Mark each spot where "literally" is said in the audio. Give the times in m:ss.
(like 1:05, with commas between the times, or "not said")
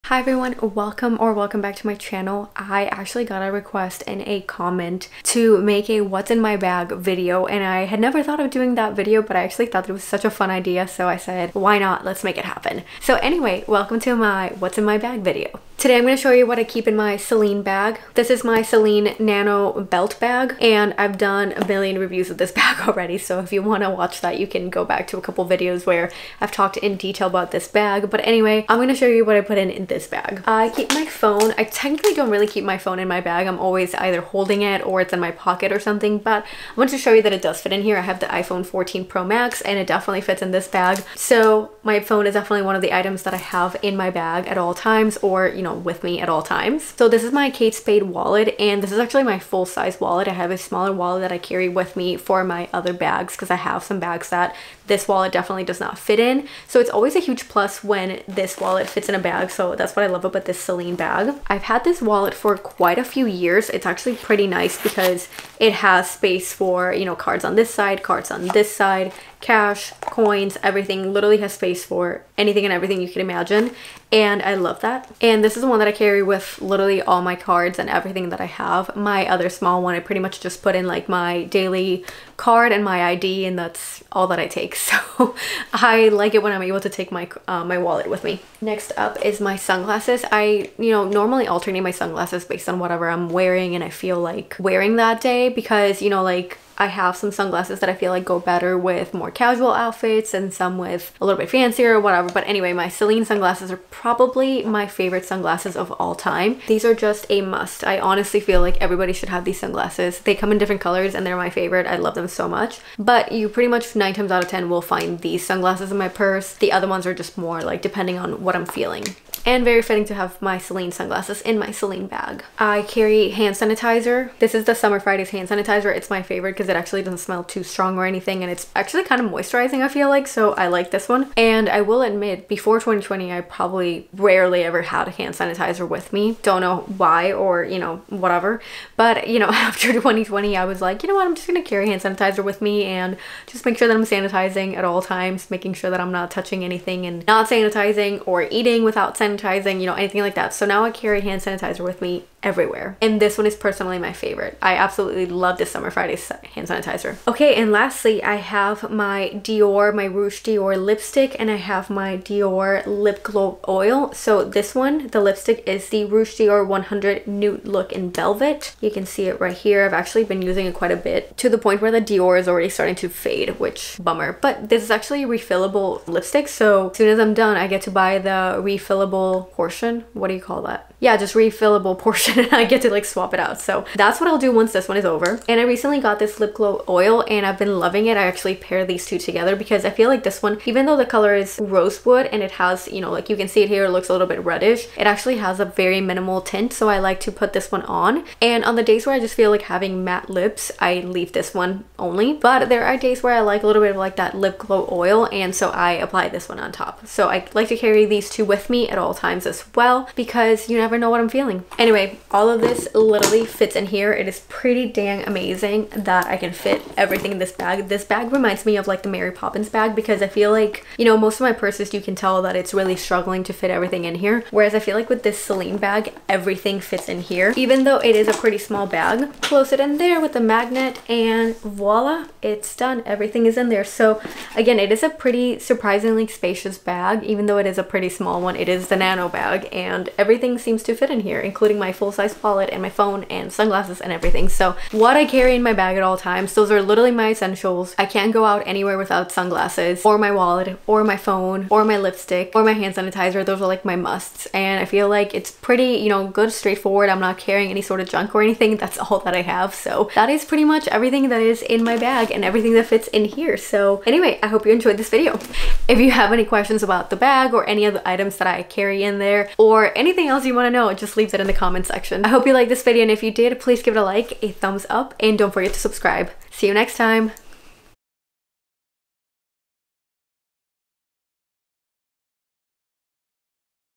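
1:11, 1:16, 3:32, 4:06.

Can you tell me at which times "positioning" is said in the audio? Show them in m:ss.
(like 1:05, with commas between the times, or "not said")
not said.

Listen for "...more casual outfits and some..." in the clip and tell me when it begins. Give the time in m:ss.
1:39.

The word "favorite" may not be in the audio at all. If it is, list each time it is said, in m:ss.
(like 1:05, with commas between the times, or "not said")
1:44, 1:51, 2:06, 2:34.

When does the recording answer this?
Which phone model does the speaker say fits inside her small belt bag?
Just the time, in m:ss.
0:38.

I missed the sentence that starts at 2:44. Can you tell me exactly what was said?
So this one, the lipstick is the Rouge Dior 100 Nude Look in Velvet.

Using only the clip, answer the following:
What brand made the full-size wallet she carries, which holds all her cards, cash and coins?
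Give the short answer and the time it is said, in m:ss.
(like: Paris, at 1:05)
Kate Spade, at 0:47.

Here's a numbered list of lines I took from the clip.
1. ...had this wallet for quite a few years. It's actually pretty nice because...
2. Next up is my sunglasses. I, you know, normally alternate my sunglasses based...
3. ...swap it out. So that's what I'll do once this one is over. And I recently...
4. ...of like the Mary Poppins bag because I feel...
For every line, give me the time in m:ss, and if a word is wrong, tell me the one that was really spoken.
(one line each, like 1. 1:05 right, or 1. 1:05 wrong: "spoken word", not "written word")
1. 1:01 right
2. 1:28 right
3. 3:03 right
4. 3:38 right.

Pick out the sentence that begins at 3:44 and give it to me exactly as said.
Whereas I feel like with this Celine bag, everything fits in here.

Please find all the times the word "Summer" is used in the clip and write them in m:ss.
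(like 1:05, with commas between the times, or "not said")
2:04, 2:35.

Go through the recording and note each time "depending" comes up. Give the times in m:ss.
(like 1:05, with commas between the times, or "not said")
1:57.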